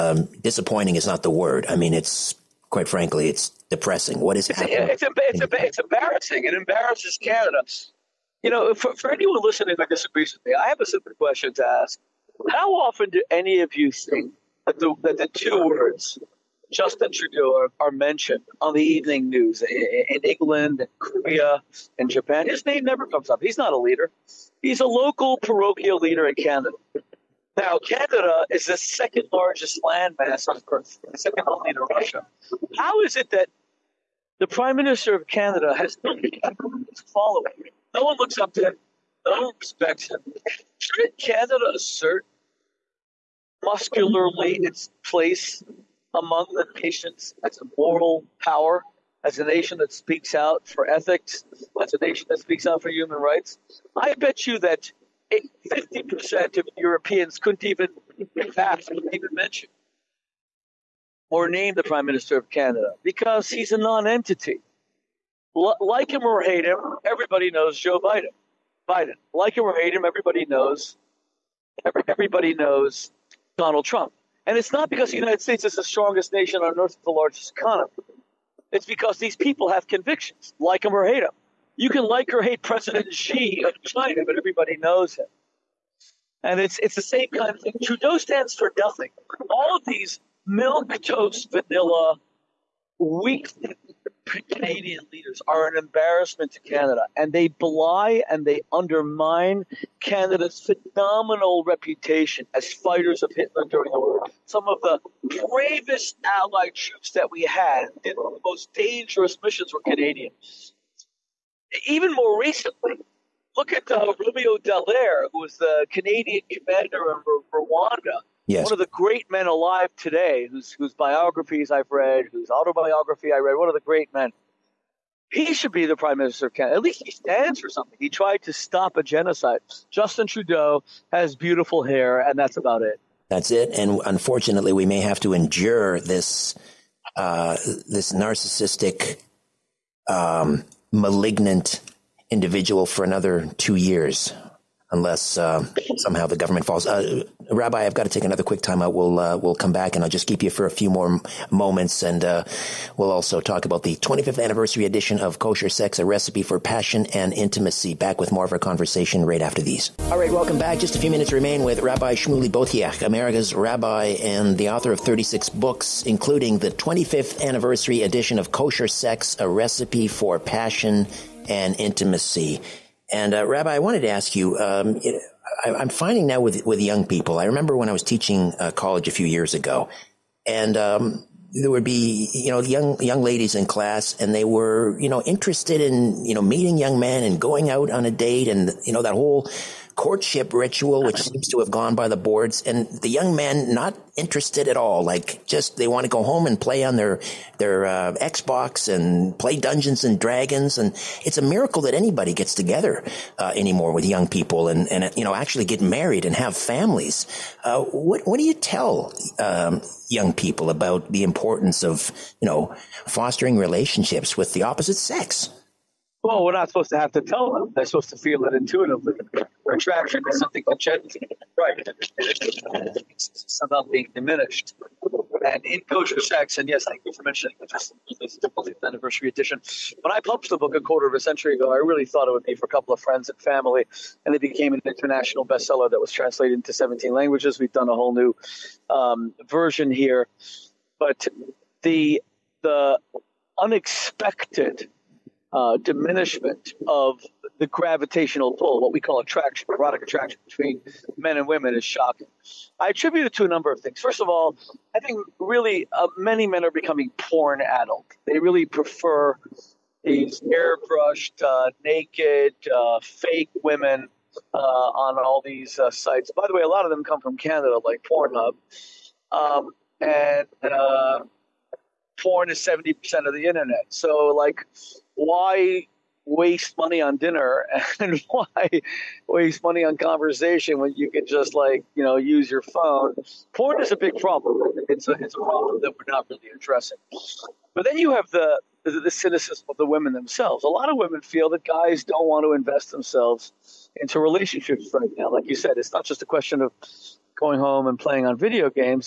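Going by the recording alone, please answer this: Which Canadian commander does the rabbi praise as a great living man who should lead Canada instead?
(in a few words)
Romeo Dallaire.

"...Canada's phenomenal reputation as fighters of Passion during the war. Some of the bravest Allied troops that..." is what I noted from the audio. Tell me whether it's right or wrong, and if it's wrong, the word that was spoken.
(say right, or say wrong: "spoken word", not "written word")
wrong: "Hitler", not "Passion".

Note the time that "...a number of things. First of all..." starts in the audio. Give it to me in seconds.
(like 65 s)
253 s.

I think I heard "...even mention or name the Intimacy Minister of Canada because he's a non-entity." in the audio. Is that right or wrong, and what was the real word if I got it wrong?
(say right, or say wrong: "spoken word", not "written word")
wrong: "Prime", not "Intimacy".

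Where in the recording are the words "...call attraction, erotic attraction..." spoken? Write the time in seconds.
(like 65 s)
248 s.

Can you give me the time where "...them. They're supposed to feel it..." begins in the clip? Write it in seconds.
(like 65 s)
217 s.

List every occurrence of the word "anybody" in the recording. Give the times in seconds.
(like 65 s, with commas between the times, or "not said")
201 s.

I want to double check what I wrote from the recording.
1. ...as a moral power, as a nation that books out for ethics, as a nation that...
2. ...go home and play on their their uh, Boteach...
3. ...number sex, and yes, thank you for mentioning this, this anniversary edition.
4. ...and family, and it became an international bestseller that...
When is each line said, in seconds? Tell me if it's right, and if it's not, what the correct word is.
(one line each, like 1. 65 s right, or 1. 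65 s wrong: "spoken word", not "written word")
1. 47 s wrong: "speaks", not "books"
2. 196 s wrong: "Xbox", not "Boteach"
3. 225 s wrong: "kosher", not "number"
4. 233 s right.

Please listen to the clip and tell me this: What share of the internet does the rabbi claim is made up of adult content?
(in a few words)
70%.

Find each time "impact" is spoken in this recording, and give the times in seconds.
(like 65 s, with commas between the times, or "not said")
not said.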